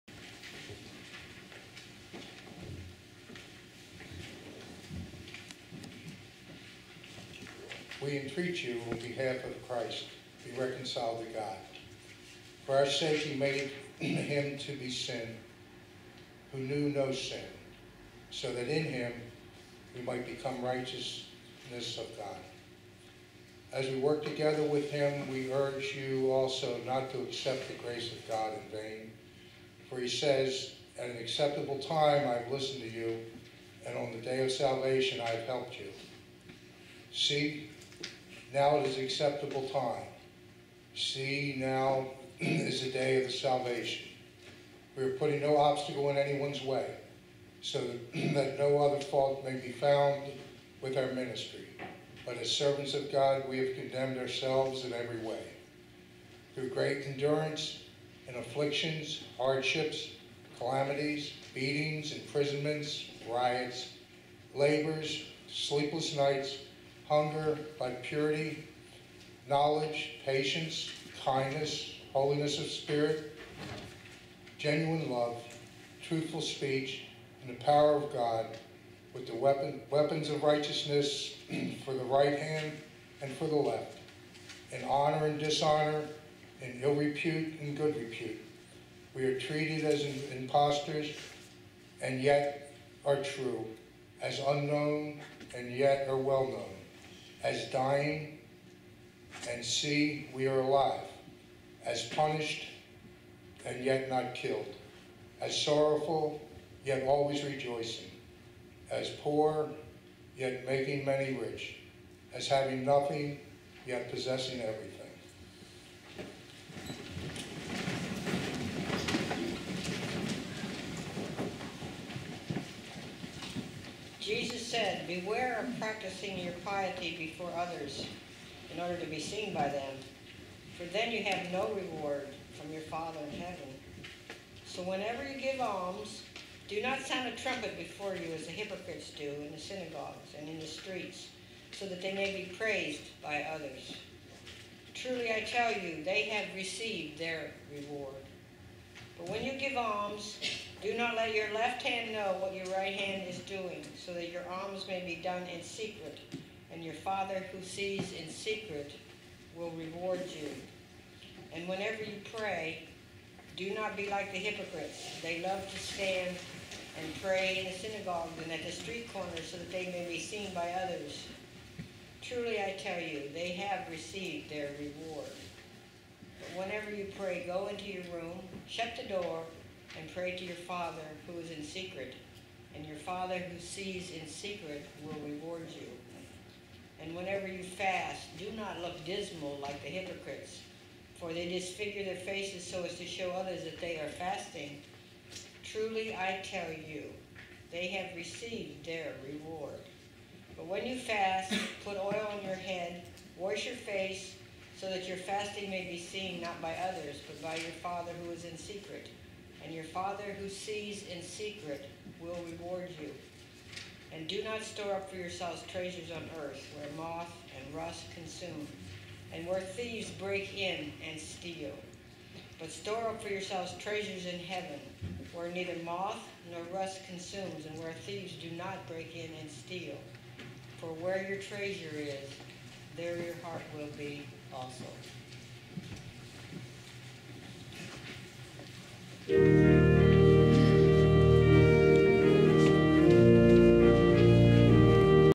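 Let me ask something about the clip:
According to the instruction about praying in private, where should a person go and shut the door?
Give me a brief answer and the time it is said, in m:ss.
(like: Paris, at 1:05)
Into your room, at 2:58.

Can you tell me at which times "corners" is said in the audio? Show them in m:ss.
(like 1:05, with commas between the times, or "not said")
2:49.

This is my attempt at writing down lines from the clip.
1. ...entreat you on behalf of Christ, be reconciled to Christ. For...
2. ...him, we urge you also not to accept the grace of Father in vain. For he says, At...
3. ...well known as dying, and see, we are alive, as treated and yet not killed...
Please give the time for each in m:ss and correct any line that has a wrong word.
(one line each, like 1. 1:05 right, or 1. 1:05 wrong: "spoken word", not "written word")
1. 0:08 wrong: "God", not "Christ"
2. 0:24 wrong: "God", not "Father"
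3. 1:36 wrong: "punished", not "treated".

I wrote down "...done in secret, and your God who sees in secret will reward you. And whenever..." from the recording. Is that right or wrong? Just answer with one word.
wrong.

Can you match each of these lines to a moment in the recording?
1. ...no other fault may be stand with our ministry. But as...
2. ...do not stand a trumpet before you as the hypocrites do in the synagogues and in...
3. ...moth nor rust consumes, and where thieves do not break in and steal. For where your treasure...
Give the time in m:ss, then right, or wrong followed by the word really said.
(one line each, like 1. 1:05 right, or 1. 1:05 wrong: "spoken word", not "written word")
1. 0:48 wrong: "found", not "stand"
2. 2:16 wrong: "sound", not "stand"
3. 3:45 right.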